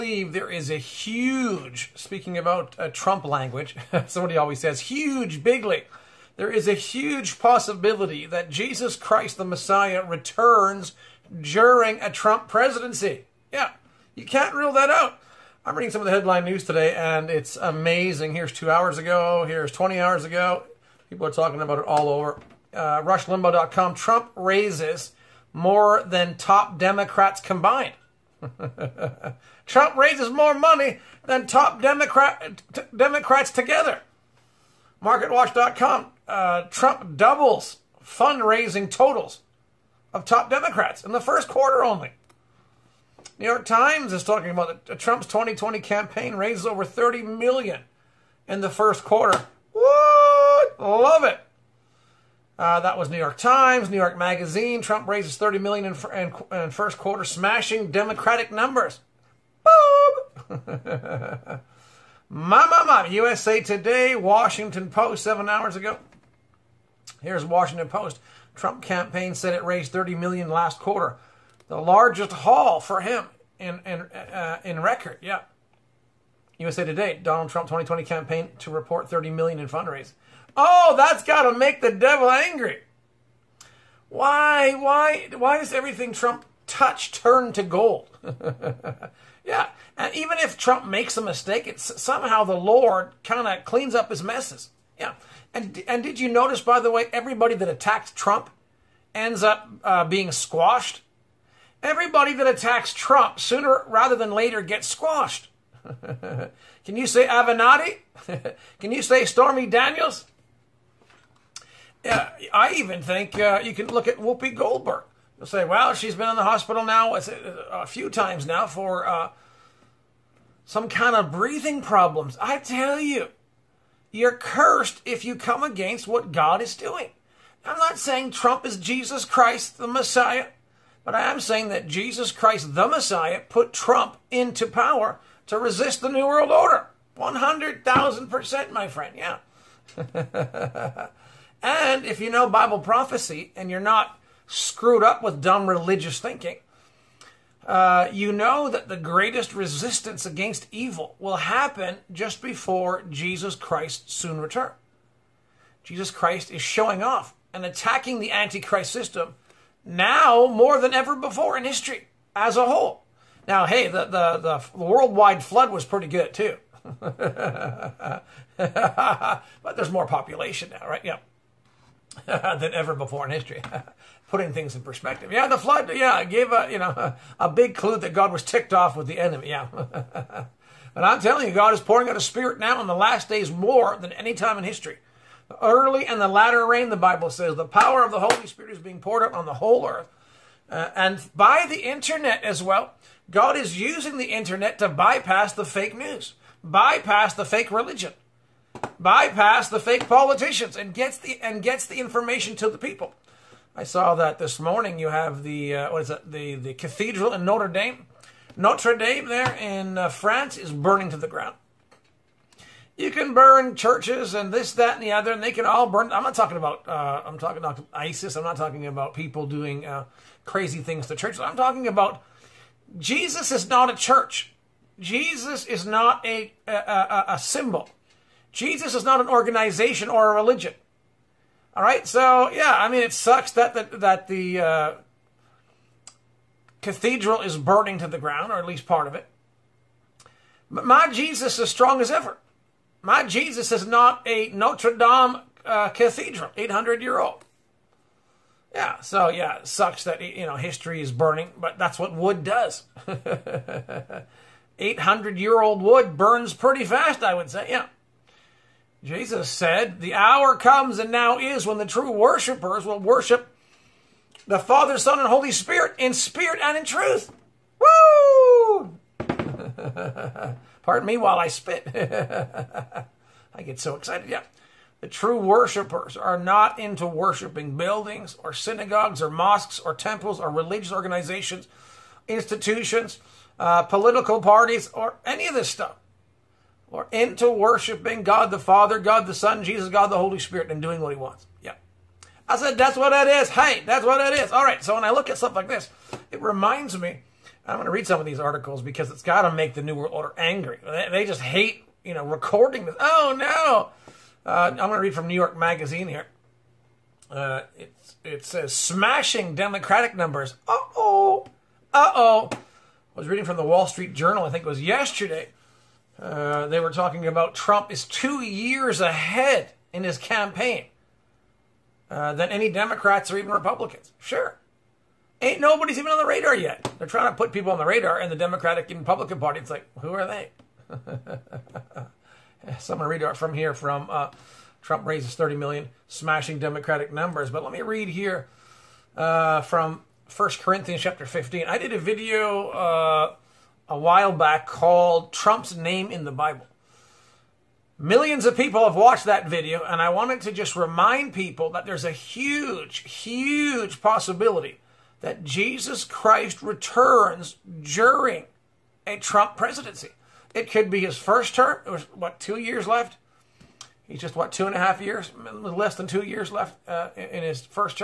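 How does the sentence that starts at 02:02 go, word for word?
I tell you, you're cursed if you come against what God is doing.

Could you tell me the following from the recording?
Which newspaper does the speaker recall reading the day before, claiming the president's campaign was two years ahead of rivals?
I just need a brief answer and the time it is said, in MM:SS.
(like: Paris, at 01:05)
Wall Street Journal, at 05:13.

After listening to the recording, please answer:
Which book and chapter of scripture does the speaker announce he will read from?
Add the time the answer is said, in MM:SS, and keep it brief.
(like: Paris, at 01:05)
First Corinthians 15, at 05:40.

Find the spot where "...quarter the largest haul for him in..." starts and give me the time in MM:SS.
01:10.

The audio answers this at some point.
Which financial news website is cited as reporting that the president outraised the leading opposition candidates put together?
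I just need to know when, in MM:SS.
00:35.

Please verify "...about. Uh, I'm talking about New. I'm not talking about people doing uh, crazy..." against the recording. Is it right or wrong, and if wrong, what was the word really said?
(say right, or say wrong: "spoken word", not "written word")
wrong: "ISIS", not "New".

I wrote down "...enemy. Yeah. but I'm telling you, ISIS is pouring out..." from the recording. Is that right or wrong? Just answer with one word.
wrong.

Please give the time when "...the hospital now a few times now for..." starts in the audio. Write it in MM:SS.
01:56.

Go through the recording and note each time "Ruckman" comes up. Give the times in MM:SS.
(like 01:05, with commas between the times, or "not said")
not said.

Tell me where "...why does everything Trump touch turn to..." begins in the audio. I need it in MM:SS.
01:25.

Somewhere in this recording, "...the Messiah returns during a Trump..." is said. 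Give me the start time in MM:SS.
00:09.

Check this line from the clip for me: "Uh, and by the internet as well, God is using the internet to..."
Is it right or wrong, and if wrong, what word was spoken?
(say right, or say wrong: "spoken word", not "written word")
right.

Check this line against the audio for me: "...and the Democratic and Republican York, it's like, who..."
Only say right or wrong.
wrong.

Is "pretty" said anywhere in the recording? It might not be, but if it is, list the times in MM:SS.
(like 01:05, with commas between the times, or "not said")
02:45, 04:16.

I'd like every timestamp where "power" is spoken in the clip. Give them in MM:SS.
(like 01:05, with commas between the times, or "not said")
02:14, 03:07.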